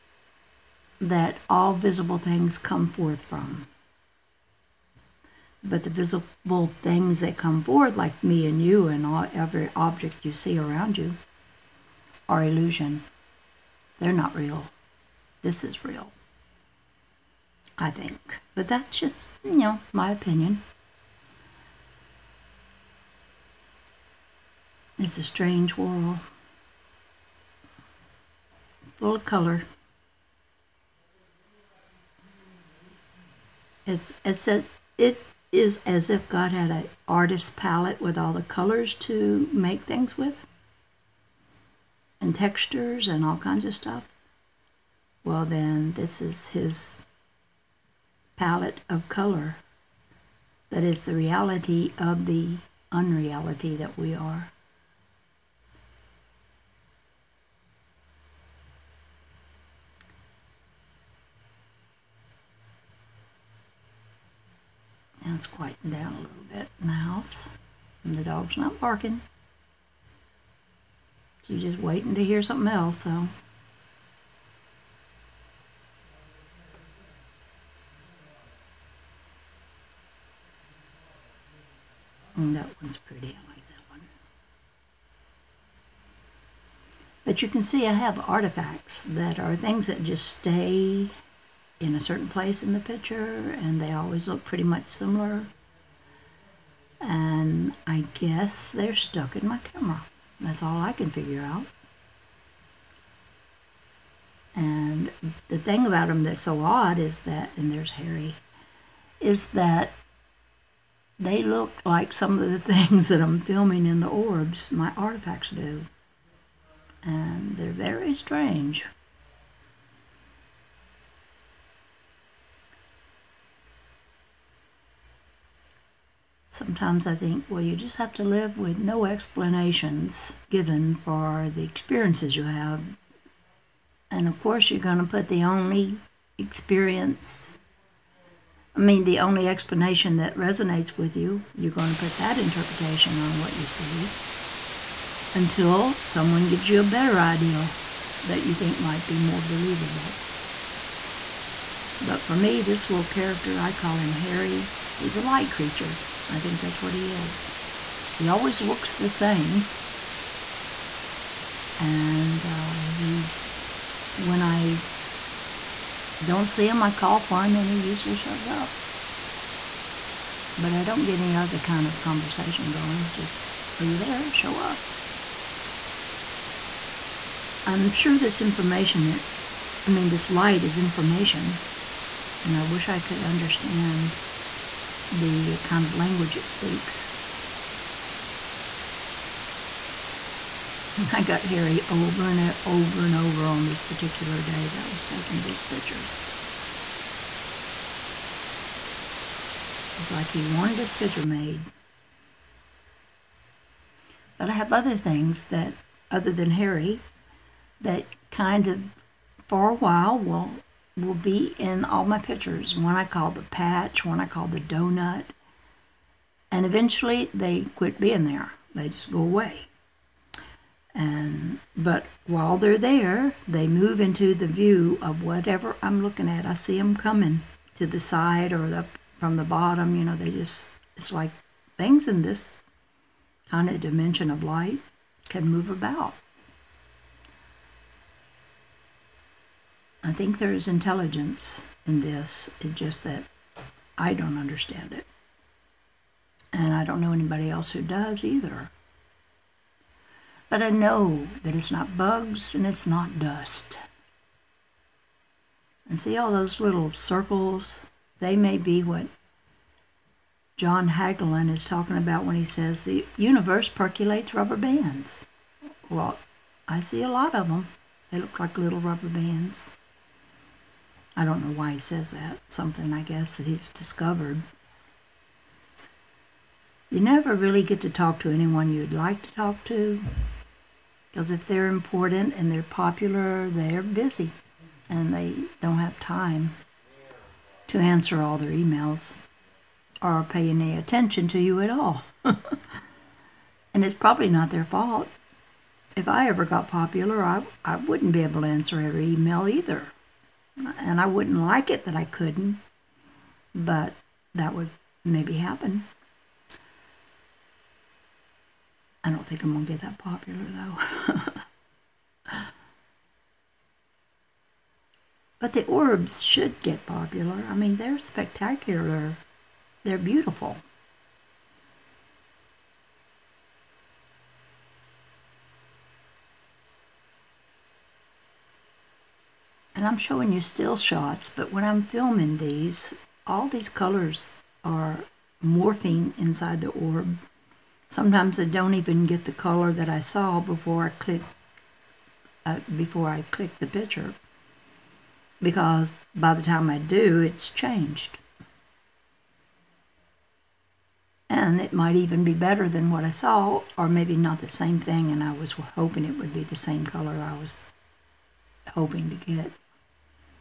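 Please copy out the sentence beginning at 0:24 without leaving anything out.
It's a strange world full color.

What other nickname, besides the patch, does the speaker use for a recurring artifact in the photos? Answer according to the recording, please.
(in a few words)
the donut.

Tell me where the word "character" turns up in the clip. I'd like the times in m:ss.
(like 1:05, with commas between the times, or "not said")
2:33.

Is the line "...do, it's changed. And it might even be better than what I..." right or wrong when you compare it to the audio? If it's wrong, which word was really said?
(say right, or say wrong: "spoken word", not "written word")
right.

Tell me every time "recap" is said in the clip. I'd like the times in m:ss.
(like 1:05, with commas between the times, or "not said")
not said.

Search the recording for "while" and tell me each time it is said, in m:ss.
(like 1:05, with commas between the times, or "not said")
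3:29, 3:42.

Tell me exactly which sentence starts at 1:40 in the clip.
That's all I can figure out.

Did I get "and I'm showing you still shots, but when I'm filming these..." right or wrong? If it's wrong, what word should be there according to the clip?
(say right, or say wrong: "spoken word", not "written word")
right.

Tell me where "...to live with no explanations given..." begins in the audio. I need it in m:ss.
2:08.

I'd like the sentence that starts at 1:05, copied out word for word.
Now it's quieting down a little bit in the house.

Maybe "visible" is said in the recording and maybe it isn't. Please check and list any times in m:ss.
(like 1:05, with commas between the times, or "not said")
0:01, 0:05.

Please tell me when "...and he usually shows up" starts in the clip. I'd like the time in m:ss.
2:47.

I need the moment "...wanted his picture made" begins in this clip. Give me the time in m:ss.
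3:20.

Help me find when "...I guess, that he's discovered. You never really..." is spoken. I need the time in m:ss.
4:32.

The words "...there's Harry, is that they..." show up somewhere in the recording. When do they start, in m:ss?
1:47.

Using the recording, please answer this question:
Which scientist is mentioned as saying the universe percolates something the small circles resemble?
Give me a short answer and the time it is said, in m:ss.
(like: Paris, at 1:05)
John Hagelin, at 4:20.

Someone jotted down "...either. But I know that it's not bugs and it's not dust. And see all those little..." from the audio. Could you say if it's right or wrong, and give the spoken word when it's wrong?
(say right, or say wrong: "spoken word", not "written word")
right.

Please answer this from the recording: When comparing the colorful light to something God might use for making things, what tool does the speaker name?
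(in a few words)
artist palette.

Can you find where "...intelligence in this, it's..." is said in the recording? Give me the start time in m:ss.
4:00.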